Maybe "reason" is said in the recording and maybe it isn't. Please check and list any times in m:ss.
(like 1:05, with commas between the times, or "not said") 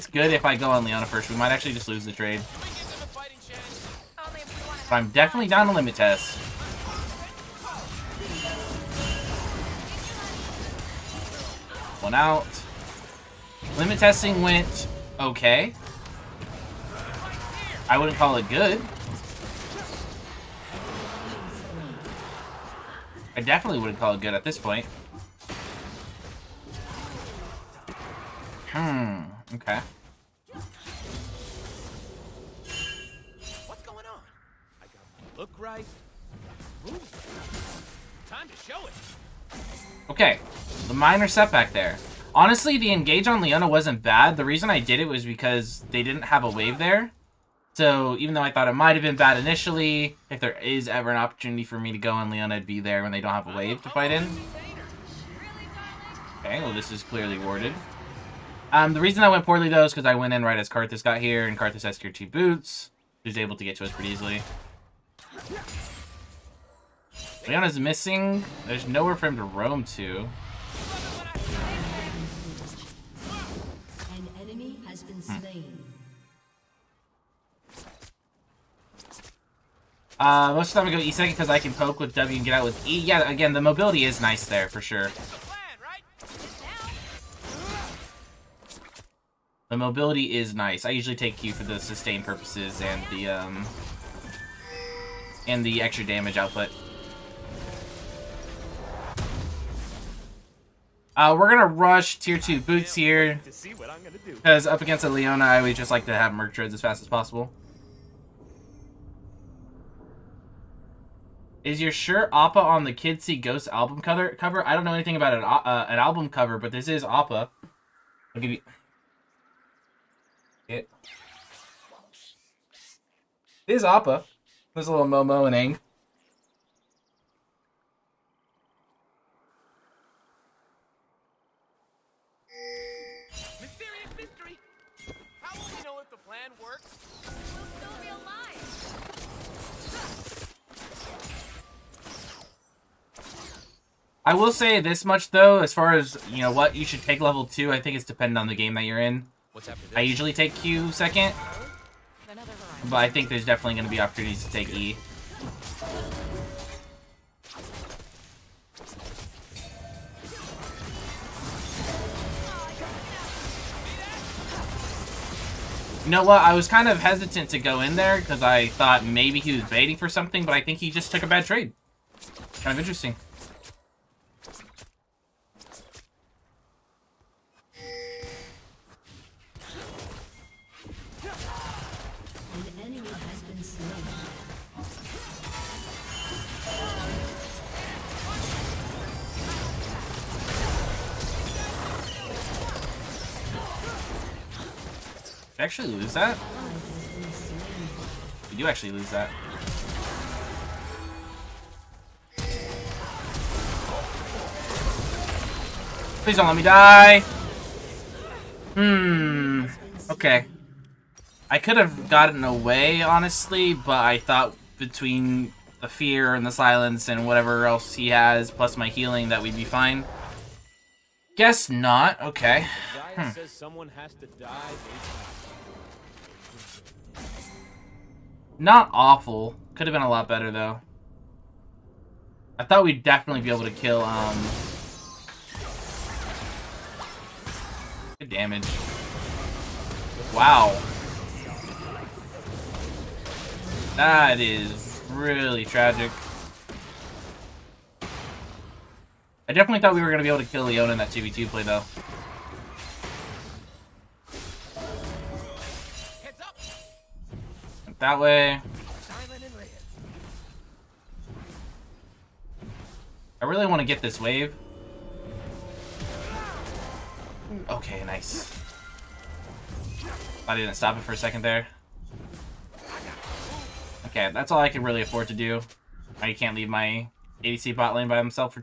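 0:44, 0:59.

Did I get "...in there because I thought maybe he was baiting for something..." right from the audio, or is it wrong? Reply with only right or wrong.
right.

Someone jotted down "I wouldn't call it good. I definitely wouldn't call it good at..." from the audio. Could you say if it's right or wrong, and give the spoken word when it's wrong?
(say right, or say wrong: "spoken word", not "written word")
right.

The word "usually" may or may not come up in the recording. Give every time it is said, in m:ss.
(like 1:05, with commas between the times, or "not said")
1:30, 2:30.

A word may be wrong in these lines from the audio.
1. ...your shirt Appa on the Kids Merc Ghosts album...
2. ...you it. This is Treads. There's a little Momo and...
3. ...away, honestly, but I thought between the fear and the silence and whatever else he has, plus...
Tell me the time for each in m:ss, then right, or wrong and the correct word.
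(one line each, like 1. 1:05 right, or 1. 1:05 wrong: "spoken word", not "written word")
1. 1:51 wrong: "See", not "Merc"
2. 1:58 wrong: "Appa", not "Treads"
3. 3:32 right.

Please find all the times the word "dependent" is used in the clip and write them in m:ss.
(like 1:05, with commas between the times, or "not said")
2:28.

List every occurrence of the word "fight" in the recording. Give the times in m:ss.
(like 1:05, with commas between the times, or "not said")
0:53.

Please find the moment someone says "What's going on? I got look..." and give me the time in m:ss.
0:33.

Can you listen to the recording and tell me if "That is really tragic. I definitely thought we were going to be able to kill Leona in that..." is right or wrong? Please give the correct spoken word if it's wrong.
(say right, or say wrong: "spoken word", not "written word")
right.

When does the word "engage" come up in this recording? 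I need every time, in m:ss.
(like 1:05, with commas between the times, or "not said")
0:42.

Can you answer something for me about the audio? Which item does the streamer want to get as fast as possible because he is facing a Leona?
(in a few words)
Merc Treads.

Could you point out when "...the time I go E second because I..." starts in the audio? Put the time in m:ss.
1:20.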